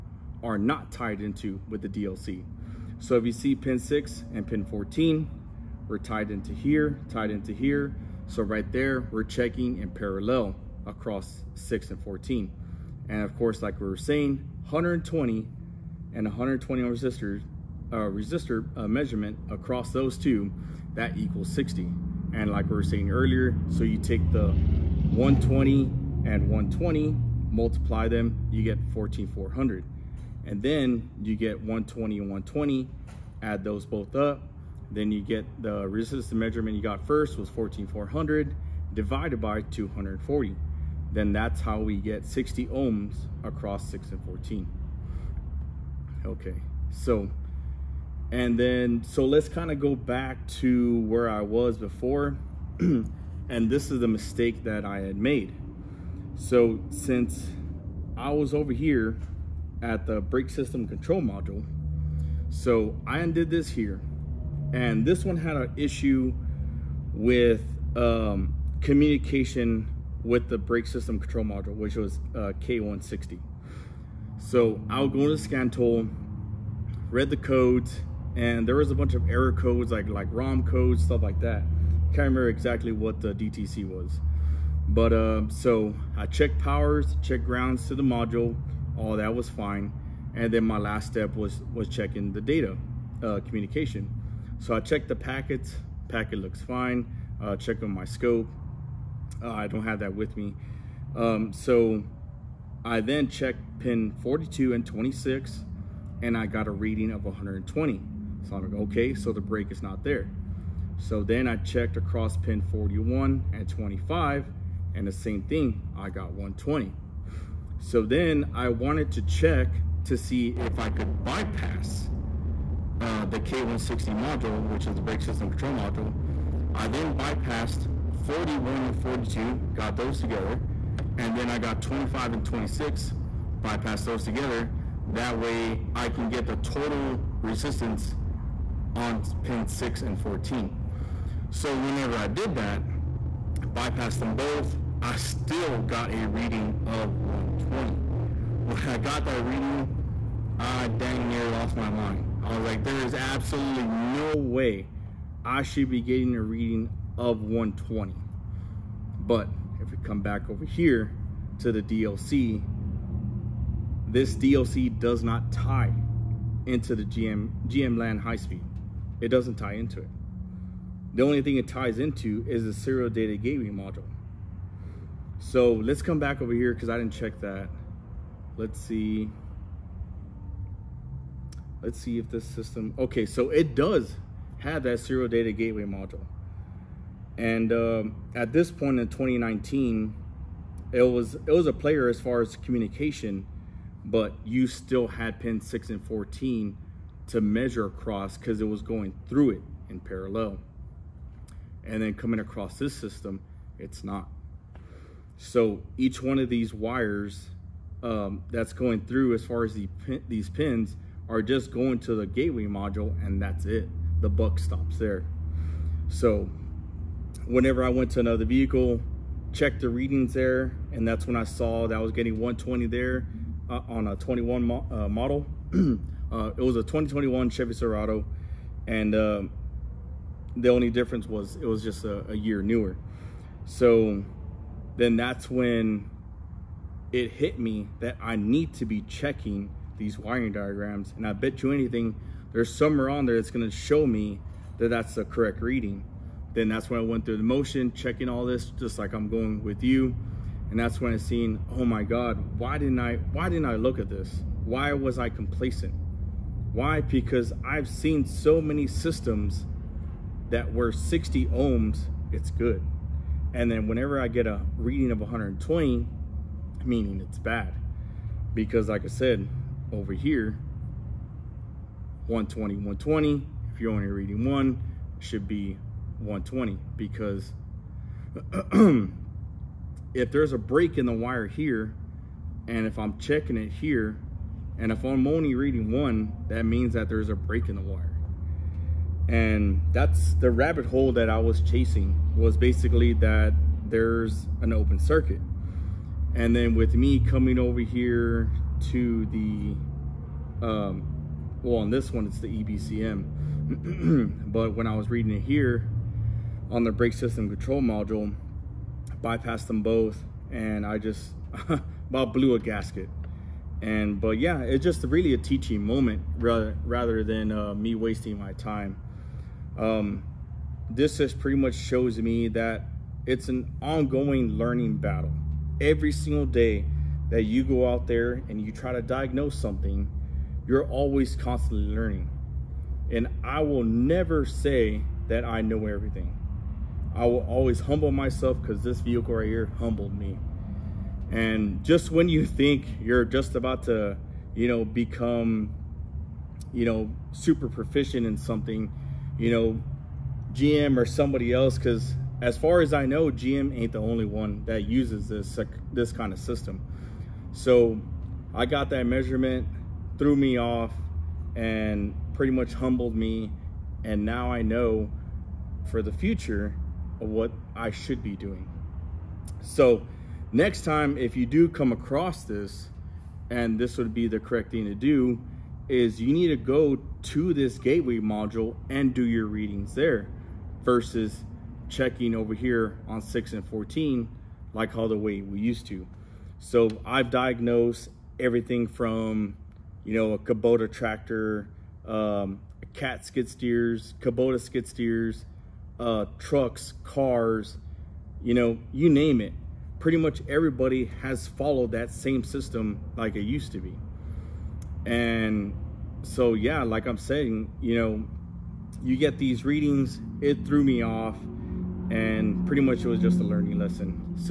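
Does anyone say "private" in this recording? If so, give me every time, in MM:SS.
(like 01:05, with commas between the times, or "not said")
not said.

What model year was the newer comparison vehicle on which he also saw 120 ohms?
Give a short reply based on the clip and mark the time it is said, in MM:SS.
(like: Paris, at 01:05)
2021, at 03:46.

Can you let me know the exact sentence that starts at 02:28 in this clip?
When I got that reading, I dang near lost my mind.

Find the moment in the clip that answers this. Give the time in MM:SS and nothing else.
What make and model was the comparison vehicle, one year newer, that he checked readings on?
03:47.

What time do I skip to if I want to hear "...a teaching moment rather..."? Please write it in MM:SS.
05:15.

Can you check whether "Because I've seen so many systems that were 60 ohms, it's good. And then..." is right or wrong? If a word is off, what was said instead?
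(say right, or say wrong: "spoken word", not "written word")
right.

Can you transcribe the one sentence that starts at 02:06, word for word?
I then bypassed 41 and 42, got those together, and then I got 25 and 26, bypassed those together.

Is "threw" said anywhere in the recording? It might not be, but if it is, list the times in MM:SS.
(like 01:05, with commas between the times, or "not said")
06:00, 06:50.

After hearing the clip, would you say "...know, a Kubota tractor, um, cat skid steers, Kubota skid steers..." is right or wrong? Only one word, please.
right.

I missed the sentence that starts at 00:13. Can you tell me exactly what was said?
And of course, like we were saying, 120 and 120 ohm resistor, uh, resistor uh, measurement across those two, that equals 60.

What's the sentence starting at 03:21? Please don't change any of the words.
And then coming across this system, it's not.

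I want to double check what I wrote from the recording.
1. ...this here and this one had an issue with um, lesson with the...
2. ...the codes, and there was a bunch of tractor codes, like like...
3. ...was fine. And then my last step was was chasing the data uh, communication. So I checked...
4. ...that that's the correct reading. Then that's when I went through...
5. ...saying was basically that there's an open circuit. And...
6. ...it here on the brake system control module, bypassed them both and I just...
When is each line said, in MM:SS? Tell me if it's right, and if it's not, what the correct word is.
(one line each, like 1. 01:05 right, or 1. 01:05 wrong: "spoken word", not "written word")
1. 01:03 wrong: "communication", not "lesson"
2. 01:17 wrong: "error", not "tractor"
3. 01:29 wrong: "checking", not "chasing"
4. 04:04 right
5. 04:51 wrong: "chasing", not "saying"
6. 05:05 right.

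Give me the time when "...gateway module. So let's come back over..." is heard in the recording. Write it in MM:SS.
02:53.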